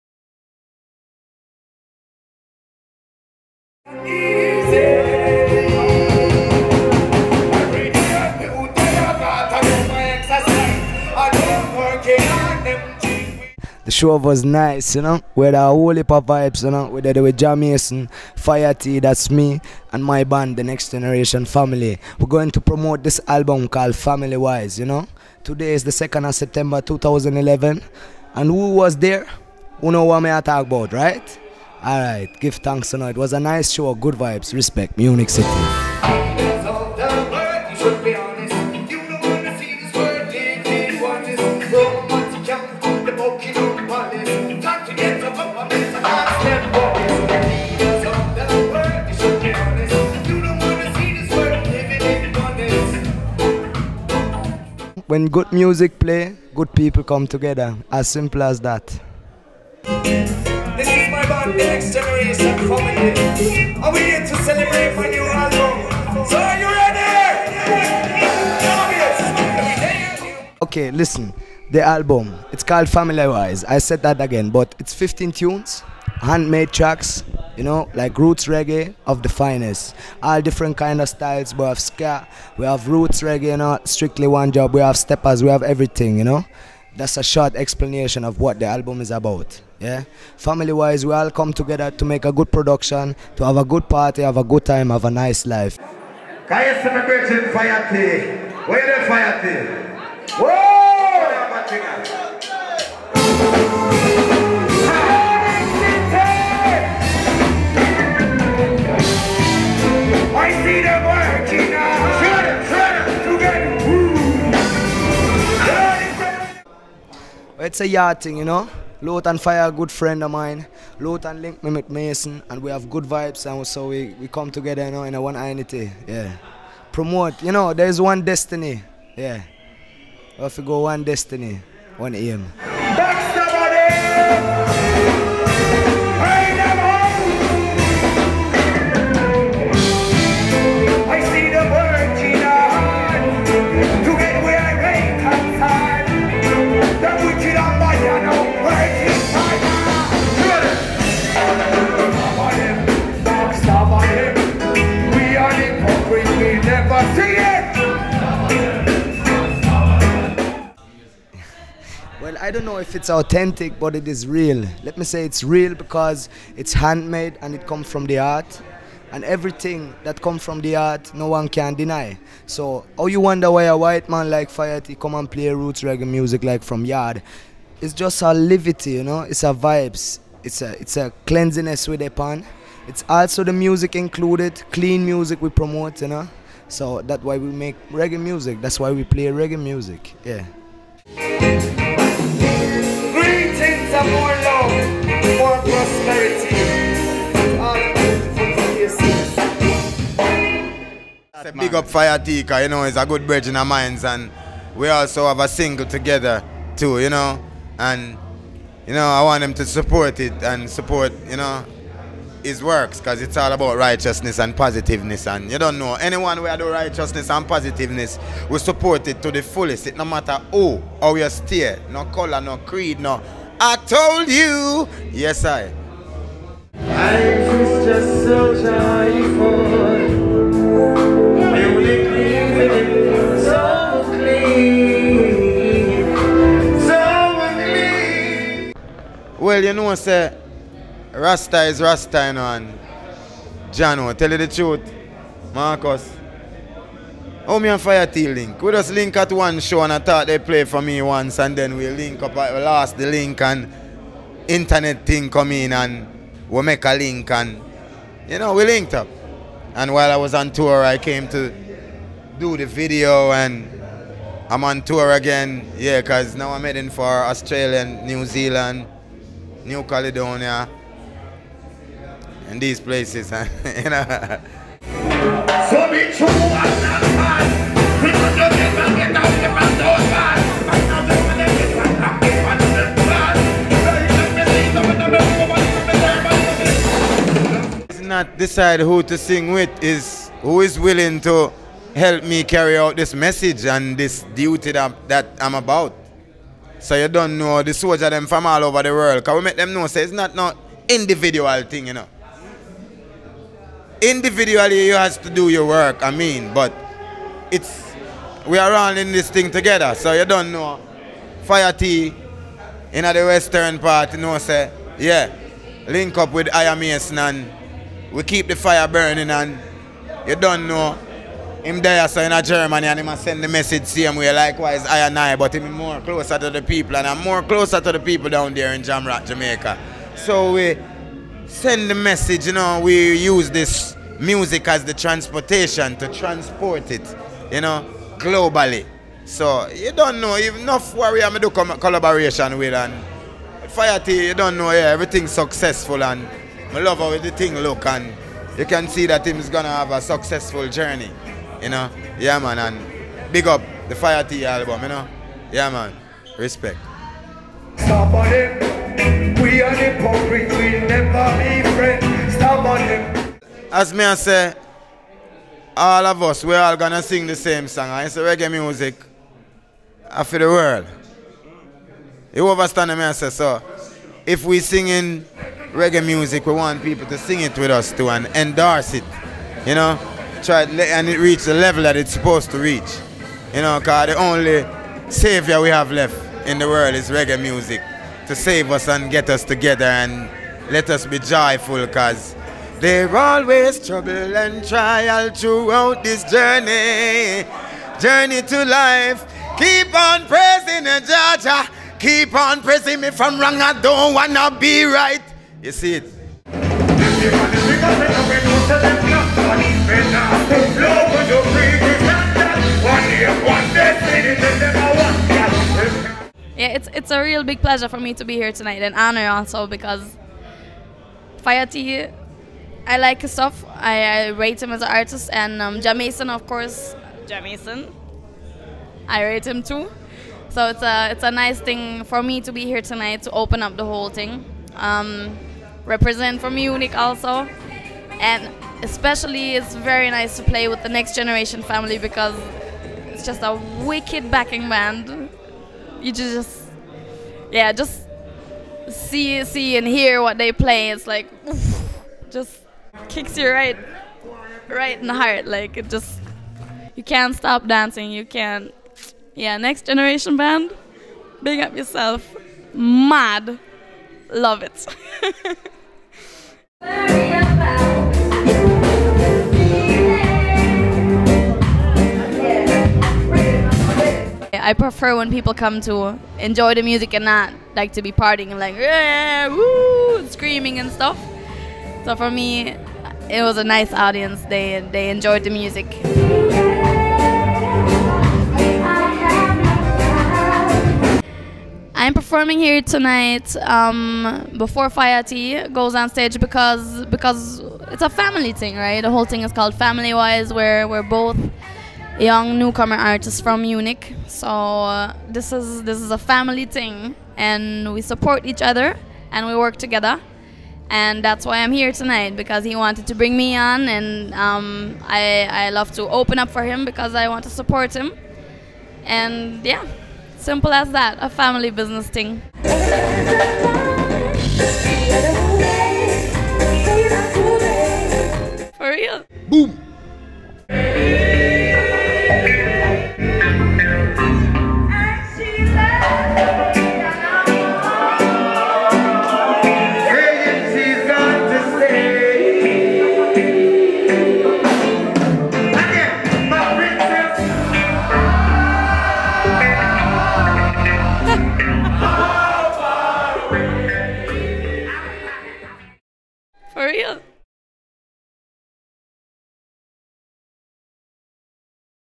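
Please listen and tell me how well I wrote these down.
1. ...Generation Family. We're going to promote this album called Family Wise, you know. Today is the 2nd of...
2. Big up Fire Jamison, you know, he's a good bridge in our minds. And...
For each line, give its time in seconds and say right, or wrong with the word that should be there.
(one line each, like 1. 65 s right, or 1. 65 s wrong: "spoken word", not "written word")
1. 20 s right
2. 201 s wrong: "Tika", not "Jamison".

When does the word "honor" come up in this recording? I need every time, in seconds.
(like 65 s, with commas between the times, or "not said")
418 s.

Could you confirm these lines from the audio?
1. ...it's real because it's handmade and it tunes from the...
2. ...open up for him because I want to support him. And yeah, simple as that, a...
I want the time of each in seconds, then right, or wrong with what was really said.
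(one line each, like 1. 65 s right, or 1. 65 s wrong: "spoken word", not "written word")
1. 165 s wrong: "comes", not "tunes"
2. 516 s right.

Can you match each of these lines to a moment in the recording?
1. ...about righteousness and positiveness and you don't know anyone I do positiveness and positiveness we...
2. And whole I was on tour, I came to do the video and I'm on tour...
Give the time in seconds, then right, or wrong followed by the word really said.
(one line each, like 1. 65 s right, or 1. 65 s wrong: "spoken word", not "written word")
1. 213 s wrong: "righteousness", not "positiveness"
2. 259 s wrong: "while", not "whole".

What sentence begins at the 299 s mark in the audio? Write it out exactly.
Can we make them know so it's not not individual thing, you know.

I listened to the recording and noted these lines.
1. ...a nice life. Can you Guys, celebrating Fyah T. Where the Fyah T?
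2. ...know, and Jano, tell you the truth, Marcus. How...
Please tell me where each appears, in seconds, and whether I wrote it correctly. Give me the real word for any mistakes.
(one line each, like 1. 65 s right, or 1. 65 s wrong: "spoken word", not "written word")
1. 95 s right
2. 242 s right.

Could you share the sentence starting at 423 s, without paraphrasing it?
I, I rate him as an artist and um, Jah Mason, of course.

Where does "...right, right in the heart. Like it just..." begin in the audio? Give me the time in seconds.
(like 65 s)
453 s.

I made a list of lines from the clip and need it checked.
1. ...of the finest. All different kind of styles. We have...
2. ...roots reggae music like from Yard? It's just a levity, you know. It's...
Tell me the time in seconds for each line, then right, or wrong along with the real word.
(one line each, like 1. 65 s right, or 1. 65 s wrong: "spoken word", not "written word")
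1. 79 s right
2. 175 s right.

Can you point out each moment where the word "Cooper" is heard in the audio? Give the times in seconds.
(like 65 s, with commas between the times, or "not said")
not said.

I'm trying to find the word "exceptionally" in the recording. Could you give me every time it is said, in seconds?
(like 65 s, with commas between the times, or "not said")
not said.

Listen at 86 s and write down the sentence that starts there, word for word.
That's a short explanation of what the album is about.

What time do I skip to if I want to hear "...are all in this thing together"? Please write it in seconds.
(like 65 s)
308 s.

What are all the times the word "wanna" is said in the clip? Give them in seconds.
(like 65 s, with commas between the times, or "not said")
404 s.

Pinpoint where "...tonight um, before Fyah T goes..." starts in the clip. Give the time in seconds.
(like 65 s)
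492 s.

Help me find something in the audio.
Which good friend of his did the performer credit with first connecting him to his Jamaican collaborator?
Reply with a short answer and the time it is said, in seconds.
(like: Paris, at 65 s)
Lothan Fire, at 119 s.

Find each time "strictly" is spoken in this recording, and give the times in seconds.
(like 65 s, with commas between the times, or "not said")
83 s.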